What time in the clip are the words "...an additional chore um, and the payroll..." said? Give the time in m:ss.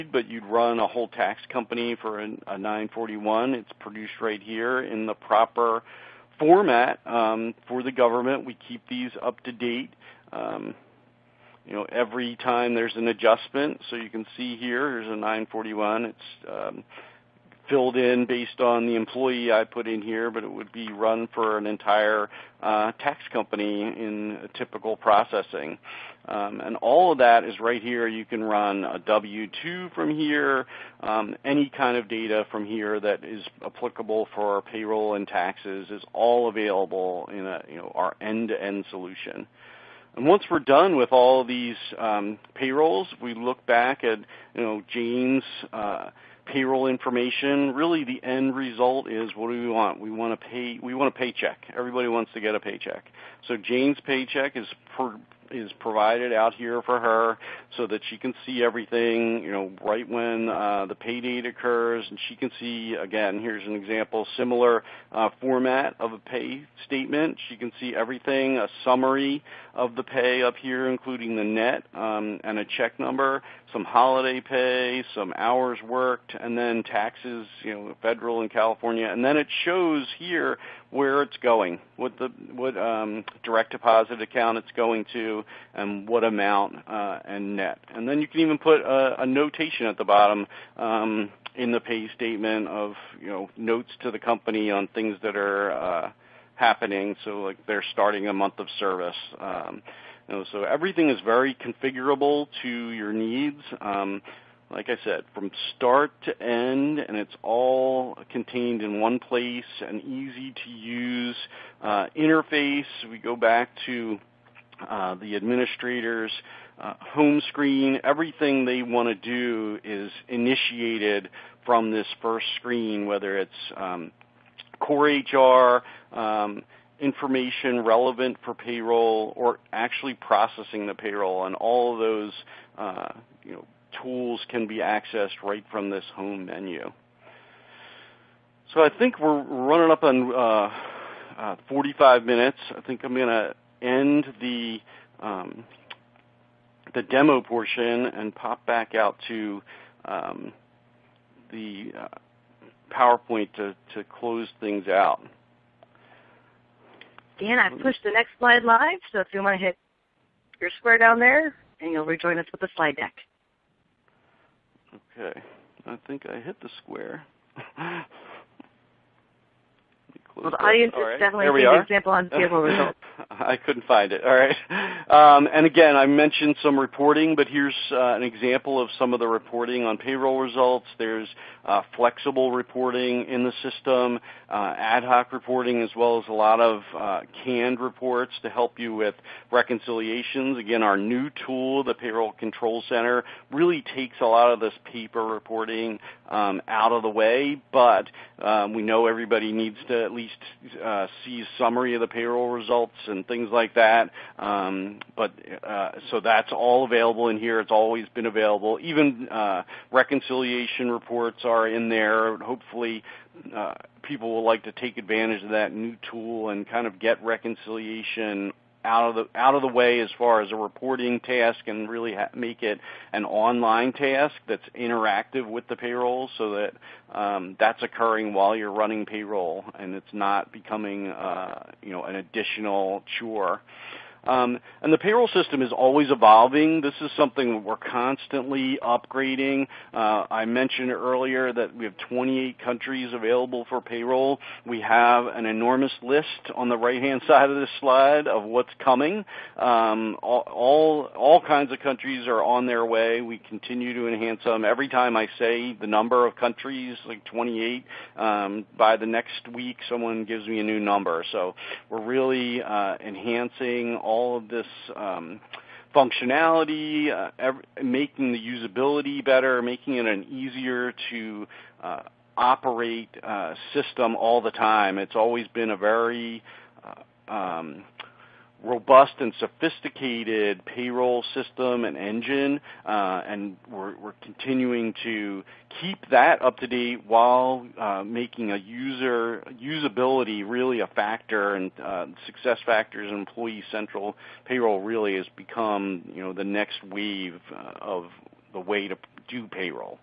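3:52.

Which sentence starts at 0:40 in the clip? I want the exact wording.
And once we're done with all these um, payrolls, we look back at you know Jane's uh, payroll information.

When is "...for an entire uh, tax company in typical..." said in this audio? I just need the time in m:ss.
0:21.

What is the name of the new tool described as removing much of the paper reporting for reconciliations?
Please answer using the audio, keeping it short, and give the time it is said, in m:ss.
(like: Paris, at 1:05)
Payroll Control Center, at 3:11.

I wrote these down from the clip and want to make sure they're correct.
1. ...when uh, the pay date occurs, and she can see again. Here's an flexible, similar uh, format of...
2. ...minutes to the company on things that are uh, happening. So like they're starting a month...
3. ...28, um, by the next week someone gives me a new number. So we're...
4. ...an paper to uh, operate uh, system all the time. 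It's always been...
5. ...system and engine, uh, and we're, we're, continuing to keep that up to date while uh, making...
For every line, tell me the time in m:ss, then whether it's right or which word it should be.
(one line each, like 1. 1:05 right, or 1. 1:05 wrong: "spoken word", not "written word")
1. 1:00 wrong: "example", not "flexible"
2. 1:33 wrong: "notes", not "minutes"
3. 4:17 right
4. 4:30 wrong: "easier", not "paper"
5. 4:41 right.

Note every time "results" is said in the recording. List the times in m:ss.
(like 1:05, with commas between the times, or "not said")
0:48, 2:52, 3:00, 3:22.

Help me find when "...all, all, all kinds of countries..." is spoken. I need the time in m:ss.
4:10.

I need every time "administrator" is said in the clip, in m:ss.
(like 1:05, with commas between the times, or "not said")
1:55.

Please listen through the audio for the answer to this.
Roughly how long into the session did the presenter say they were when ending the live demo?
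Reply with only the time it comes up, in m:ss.
2:21.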